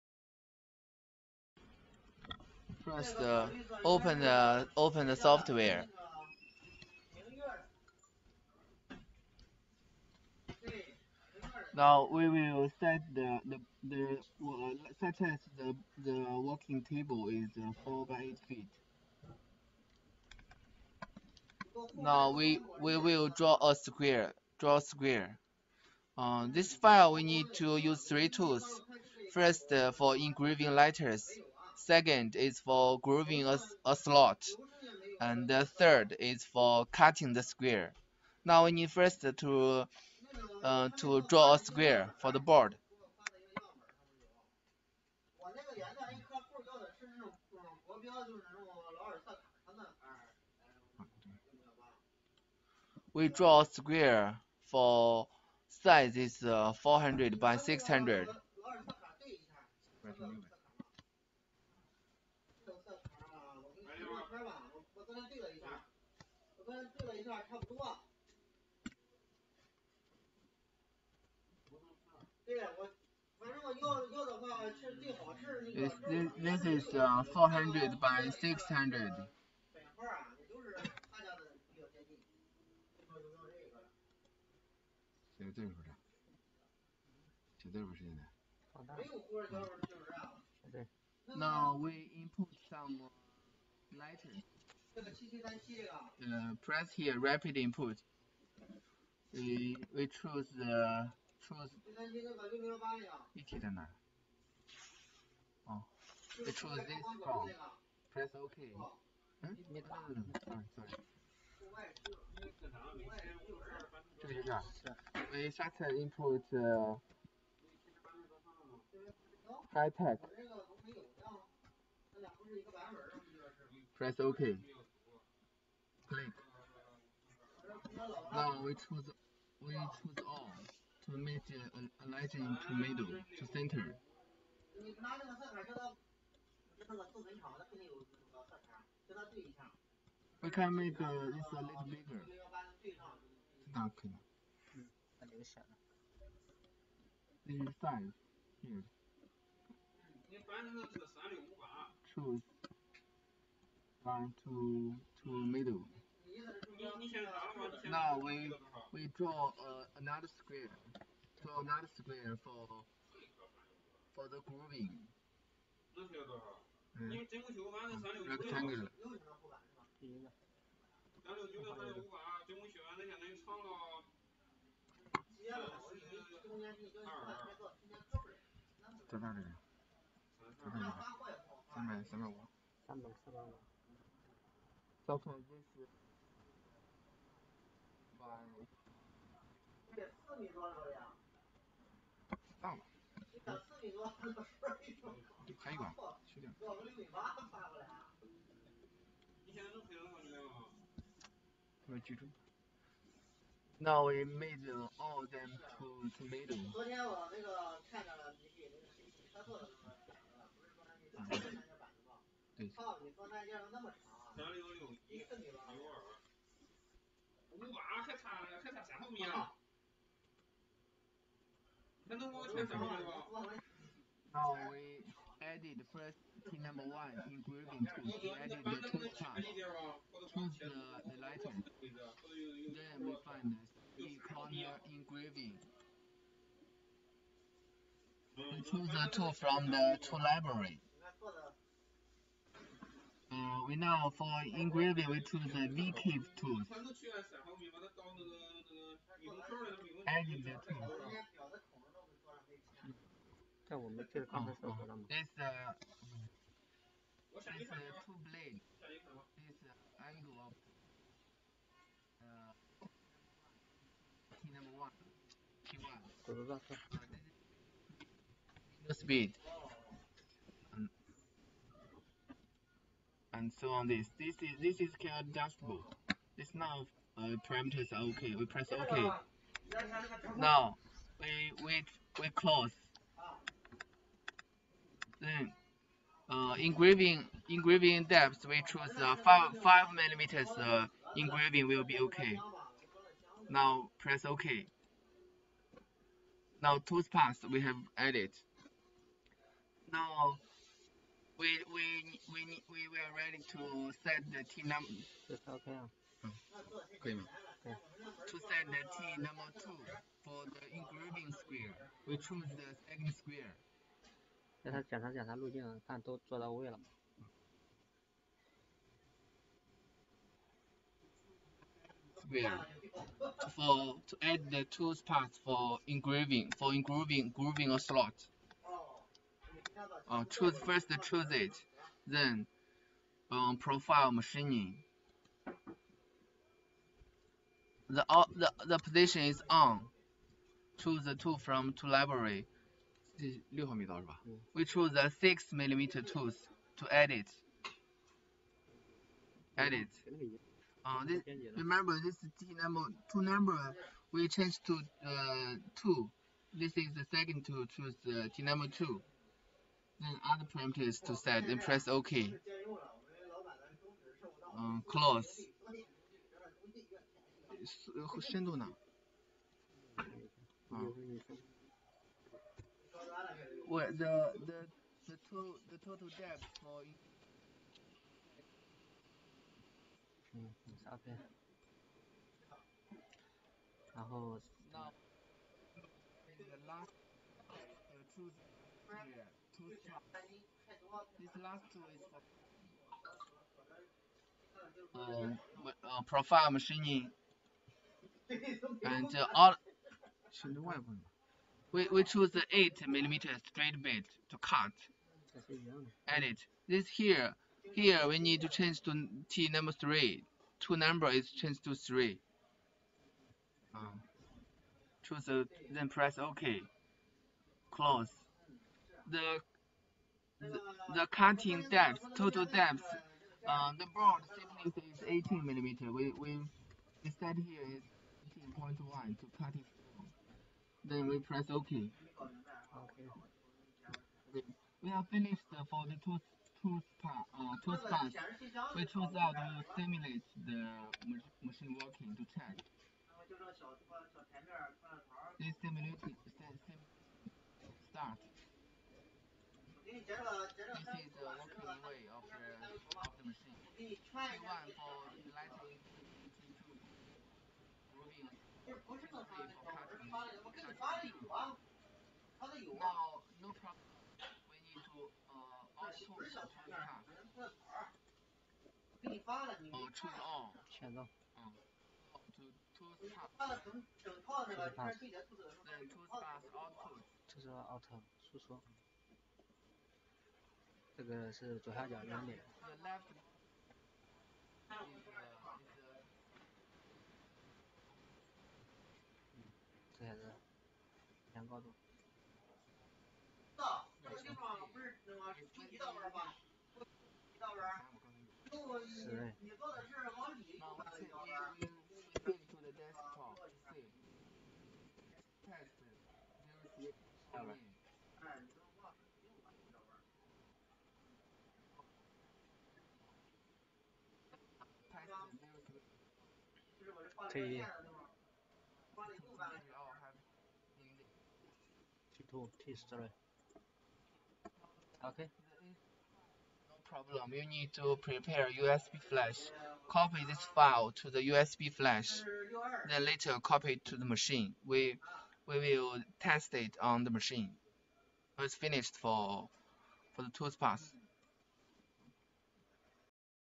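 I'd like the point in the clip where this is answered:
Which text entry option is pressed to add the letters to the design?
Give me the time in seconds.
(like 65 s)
97 s.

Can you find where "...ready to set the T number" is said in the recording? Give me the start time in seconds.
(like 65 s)
303 s.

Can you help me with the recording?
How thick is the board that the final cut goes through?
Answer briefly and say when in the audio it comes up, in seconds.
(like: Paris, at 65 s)
18 millimeter, at 425 s.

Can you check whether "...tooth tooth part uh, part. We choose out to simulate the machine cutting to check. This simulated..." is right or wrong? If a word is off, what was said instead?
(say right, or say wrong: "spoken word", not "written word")
wrong: "working", not "cutting".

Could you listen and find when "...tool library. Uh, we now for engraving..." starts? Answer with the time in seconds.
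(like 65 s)
240 s.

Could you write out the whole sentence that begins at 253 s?
但 我 没 记 得 刚 才 是 说 了 吗 ？It's a it's a two blade.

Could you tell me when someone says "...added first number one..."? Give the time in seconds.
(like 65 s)
225 s.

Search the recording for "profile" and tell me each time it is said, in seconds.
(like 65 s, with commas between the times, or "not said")
333 s, 396 s.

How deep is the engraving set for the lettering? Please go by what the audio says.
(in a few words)
5 millimeters.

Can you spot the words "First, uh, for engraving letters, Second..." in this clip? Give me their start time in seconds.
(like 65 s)
29 s.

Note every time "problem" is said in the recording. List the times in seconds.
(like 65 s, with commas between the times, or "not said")
527 s.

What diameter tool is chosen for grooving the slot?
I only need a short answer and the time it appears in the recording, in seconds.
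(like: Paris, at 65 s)
6 millimeter, at 345 s.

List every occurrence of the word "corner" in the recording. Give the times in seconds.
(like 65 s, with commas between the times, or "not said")
234 s.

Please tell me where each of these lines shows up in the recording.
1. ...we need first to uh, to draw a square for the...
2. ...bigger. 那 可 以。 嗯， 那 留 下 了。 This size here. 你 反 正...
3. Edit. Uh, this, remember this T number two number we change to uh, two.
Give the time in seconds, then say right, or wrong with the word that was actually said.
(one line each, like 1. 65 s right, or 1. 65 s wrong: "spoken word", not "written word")
1. 38 s right
2. 141 s right
3. 349 s right.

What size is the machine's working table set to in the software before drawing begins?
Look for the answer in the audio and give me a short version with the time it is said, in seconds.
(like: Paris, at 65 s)
4 by 8 feet, at 17 s.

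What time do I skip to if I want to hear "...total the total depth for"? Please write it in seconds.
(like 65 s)
375 s.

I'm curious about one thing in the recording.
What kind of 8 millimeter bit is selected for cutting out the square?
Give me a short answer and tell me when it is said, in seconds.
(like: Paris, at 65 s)
straight bit, at 403 s.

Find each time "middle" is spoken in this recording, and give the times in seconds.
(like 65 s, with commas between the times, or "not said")
132 s, 155 s.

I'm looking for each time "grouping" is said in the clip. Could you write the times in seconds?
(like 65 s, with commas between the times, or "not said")
164 s, 227 s.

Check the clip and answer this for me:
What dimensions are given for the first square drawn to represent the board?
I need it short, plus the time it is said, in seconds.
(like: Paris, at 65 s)
400 by 600, at 56 s.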